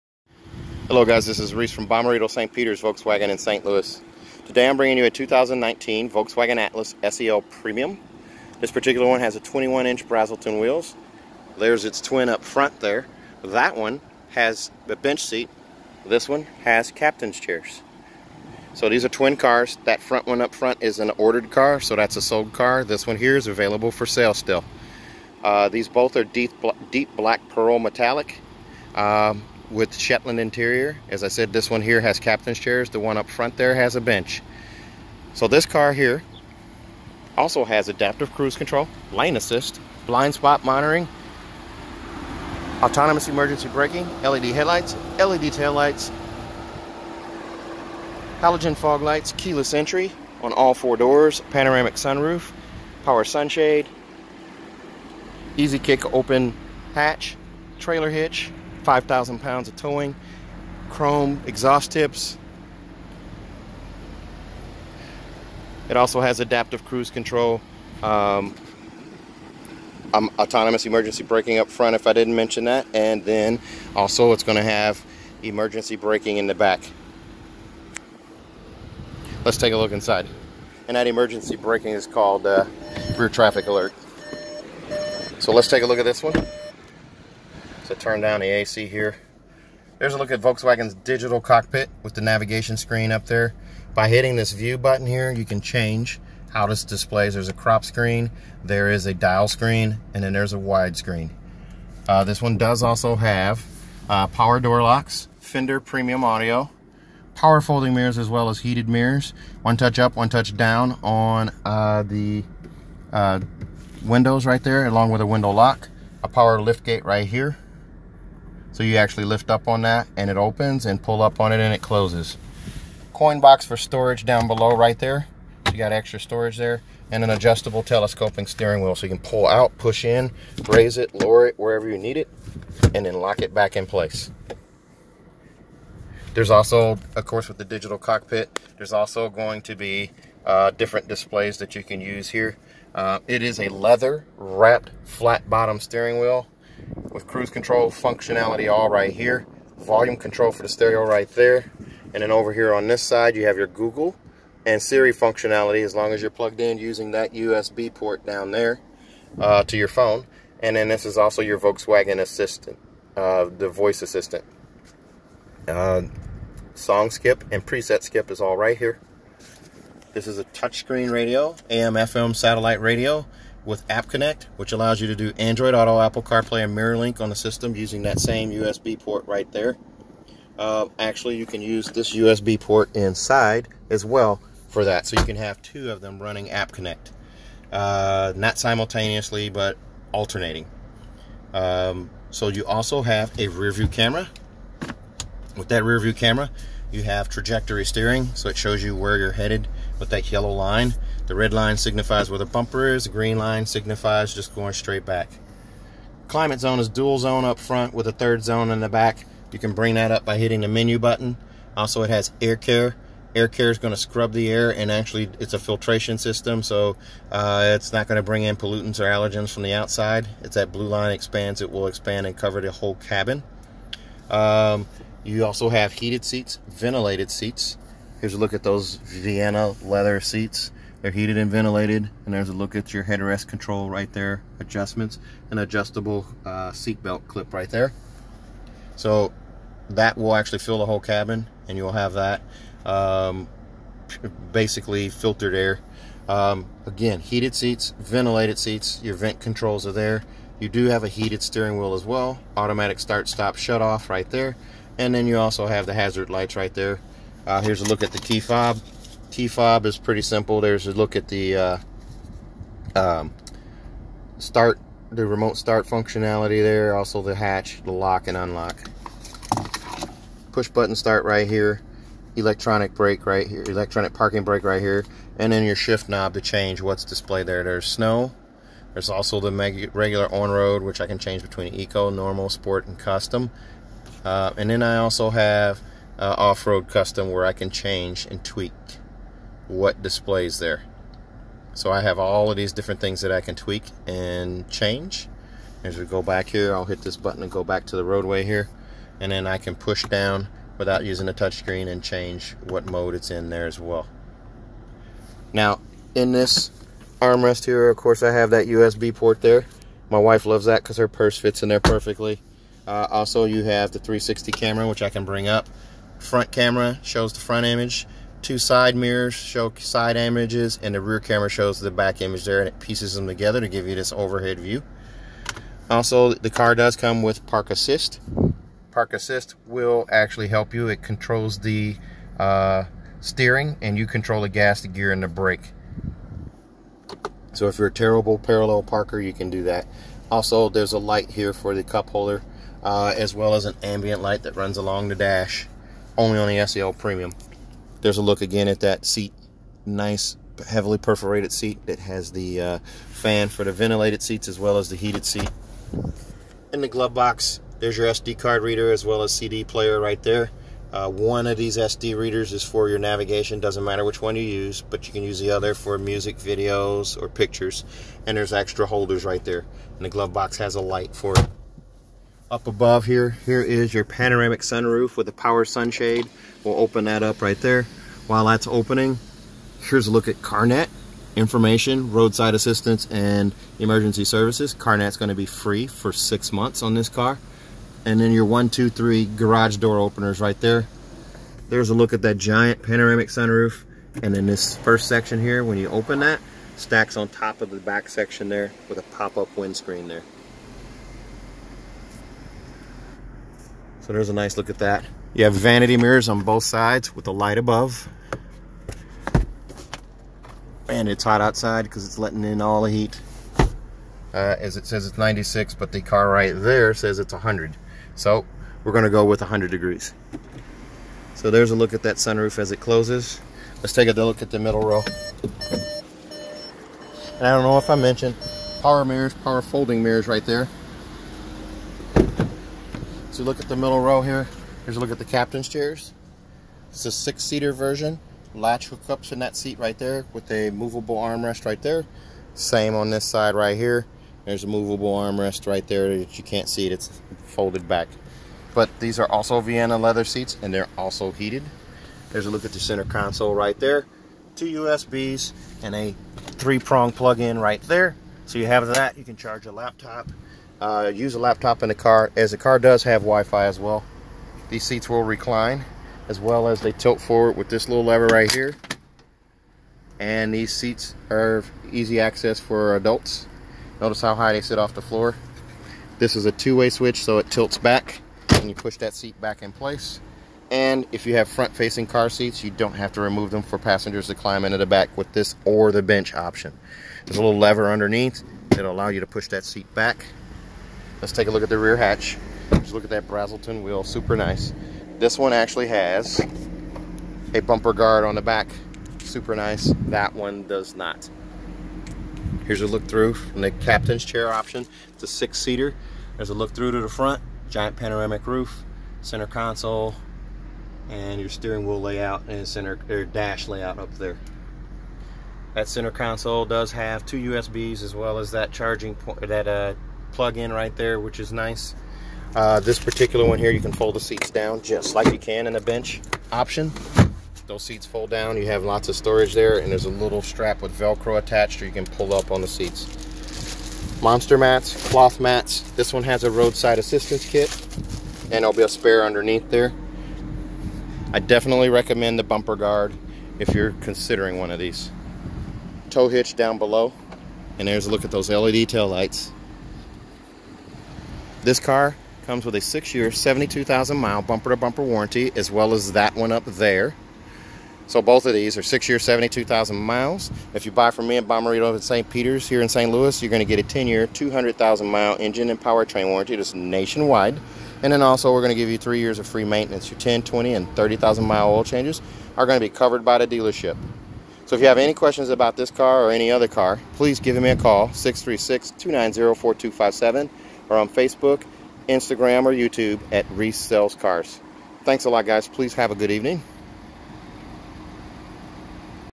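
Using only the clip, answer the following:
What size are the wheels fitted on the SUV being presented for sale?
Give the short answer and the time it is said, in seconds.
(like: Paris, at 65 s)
21 inch, at 9 s.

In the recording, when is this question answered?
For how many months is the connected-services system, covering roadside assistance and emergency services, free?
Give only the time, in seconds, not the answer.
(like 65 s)
386 s.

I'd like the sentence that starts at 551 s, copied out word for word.
This car comes with a six-year, 72,000 mile bumper-to-bumper warranty, as well as that one up there.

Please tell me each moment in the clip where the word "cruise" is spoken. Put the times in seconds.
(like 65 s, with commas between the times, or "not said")
38 s, 66 s, 147 s.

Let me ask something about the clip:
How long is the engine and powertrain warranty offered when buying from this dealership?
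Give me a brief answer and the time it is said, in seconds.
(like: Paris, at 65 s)
10 years, 200,000 miles, at 563 s.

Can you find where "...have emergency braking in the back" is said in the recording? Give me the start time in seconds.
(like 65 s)
74 s.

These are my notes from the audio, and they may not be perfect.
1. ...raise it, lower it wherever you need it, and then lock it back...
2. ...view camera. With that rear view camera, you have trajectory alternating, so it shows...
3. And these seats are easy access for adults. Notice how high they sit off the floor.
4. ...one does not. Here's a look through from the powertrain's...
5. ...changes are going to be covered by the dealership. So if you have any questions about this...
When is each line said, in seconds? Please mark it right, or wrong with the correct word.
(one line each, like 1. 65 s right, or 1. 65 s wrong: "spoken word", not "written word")
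1. 130 s right
2. 193 s wrong: "steering", not "alternating"
3. 470 s right
4. 500 s wrong: "captain", not "powertrain"
5. 571 s right.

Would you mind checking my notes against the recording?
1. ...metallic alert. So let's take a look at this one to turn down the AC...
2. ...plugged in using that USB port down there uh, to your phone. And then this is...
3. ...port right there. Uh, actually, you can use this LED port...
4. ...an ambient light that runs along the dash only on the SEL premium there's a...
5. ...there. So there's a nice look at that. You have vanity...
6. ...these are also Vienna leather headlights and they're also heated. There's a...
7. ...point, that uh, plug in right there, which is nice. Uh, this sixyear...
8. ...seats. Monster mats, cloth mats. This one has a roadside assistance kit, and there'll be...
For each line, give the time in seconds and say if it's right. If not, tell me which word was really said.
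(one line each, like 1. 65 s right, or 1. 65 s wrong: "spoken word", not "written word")
1. 83 s wrong: "traffic", not "metallic"
2. 156 s right
3. 178 s wrong: "USB", not "LED"
4. 343 s right
5. 400 s right
6. 448 s wrong: "seats", not "headlights"
7. 519 s wrong: "particular", not "sixyear"
8. 532 s right.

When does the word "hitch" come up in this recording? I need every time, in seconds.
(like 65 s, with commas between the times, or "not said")
58 s, 546 s.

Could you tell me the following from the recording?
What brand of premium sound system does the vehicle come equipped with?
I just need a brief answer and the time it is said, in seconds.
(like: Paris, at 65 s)
Fender, at 105 s.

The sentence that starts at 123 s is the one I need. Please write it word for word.
Coin box for storage down below right there.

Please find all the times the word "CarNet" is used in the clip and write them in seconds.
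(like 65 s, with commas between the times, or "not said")
380 s, 384 s.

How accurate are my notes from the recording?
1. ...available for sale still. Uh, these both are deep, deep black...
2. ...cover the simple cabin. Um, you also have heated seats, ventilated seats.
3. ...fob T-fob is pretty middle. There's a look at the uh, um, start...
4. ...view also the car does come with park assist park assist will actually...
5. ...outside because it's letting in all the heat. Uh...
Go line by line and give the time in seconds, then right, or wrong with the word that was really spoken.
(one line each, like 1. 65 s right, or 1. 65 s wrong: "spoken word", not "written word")
1. 23 s right
2. 222 s wrong: "whole", not "simple"
3. 258 s wrong: "simple", not "middle"
4. 324 s right
5. 411 s right.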